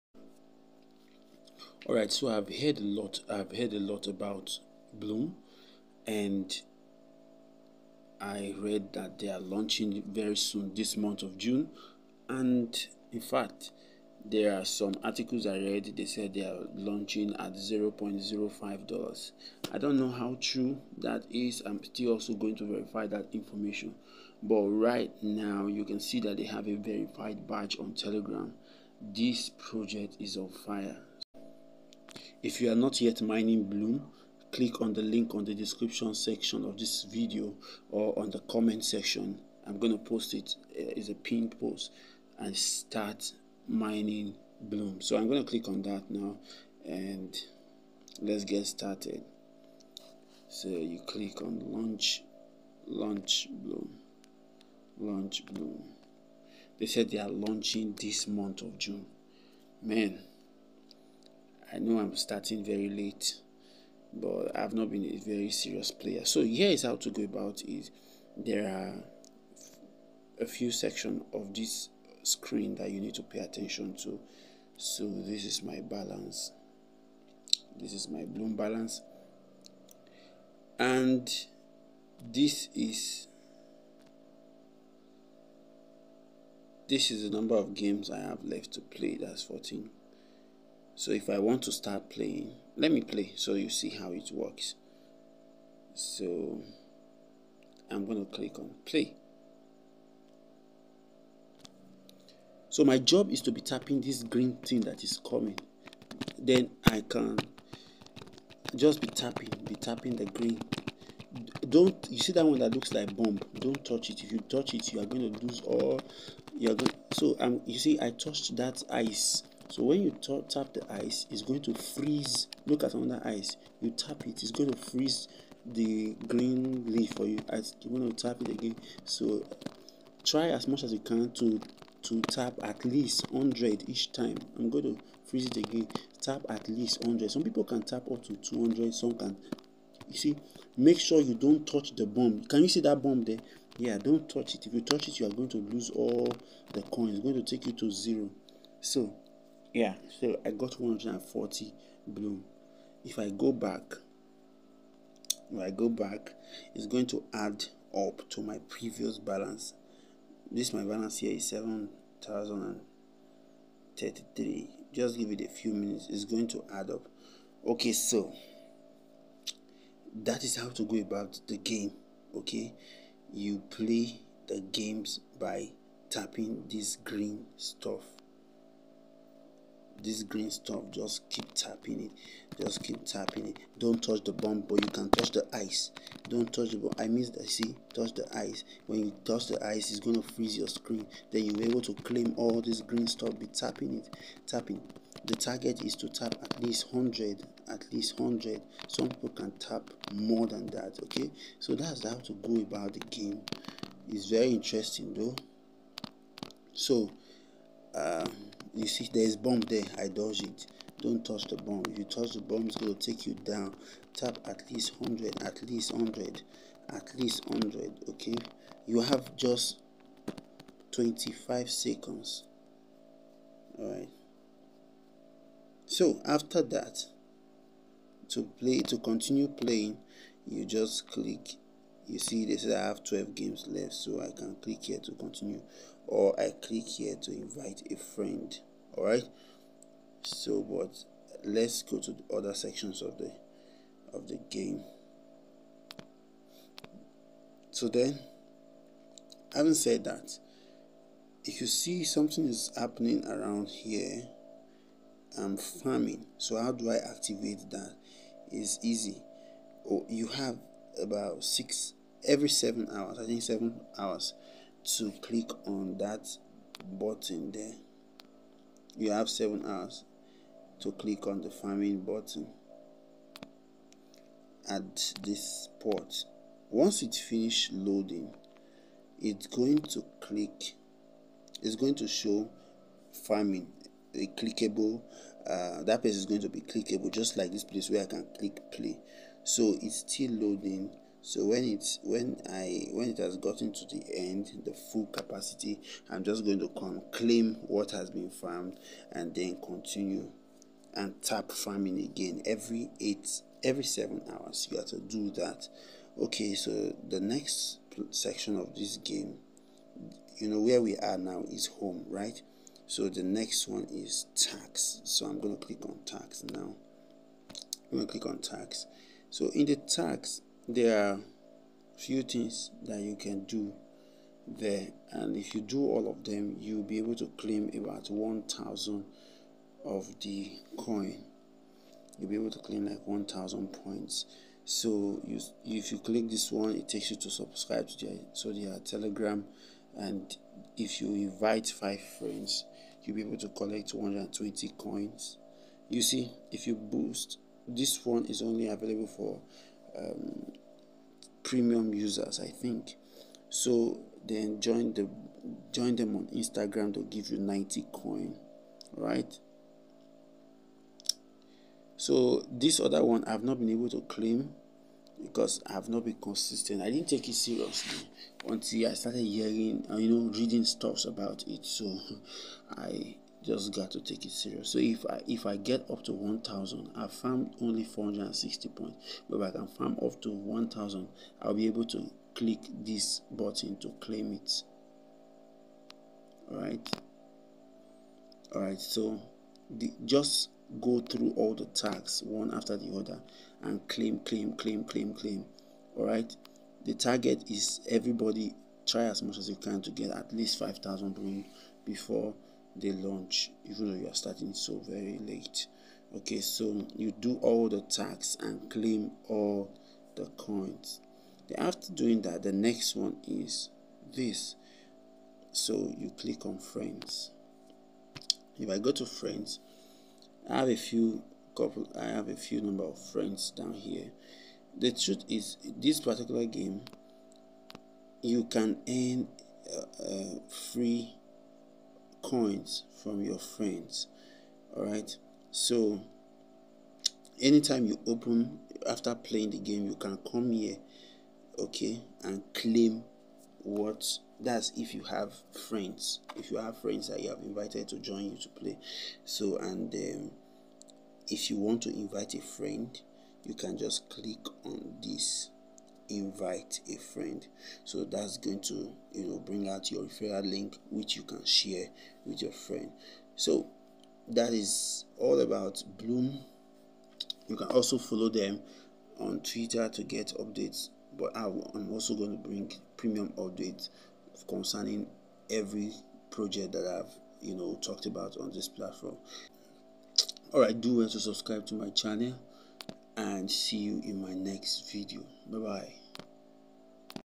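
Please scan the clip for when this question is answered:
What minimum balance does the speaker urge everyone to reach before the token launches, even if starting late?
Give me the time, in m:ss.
6:40.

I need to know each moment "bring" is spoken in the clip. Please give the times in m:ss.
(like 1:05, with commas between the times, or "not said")
7:39, 7:52.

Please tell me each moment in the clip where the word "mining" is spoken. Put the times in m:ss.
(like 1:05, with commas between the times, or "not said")
0:33, 0:43.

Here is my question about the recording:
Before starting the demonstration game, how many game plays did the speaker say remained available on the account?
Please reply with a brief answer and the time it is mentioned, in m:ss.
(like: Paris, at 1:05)
14, at 1:29.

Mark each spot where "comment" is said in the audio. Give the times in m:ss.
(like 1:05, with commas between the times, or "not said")
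0:38.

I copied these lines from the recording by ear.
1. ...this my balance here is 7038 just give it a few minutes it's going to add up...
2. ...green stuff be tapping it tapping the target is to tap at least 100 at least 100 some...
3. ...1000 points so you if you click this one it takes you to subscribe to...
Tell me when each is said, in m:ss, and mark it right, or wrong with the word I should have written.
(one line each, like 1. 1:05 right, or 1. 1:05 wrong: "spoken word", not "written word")
1. 2:40 wrong: "7033", not "7038"
2. 3:12 right
3. 5:33 right.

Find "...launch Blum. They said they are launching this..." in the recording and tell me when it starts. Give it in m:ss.
0:54.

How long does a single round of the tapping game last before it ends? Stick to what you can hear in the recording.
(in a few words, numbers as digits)
25 seconds.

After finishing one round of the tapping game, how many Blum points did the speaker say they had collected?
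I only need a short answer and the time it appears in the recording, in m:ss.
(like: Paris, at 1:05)
140, at 2:30.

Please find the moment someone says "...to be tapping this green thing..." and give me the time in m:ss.
1:43.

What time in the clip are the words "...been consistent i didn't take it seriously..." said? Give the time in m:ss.
6:06.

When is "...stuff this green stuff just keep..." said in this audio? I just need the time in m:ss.
2:57.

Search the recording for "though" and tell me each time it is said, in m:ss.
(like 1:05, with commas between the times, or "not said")
3:25, 6:43.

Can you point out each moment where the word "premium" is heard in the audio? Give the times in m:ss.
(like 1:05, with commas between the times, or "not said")
5:51, 7:52.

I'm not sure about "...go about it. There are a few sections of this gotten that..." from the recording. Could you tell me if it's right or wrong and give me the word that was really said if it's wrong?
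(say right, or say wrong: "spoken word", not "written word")
wrong: "screen", not "gotten".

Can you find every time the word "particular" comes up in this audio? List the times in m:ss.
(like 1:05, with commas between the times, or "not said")
7:05.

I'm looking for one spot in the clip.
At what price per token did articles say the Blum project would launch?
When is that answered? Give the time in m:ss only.
0:17.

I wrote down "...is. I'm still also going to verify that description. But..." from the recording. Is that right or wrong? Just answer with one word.
wrong.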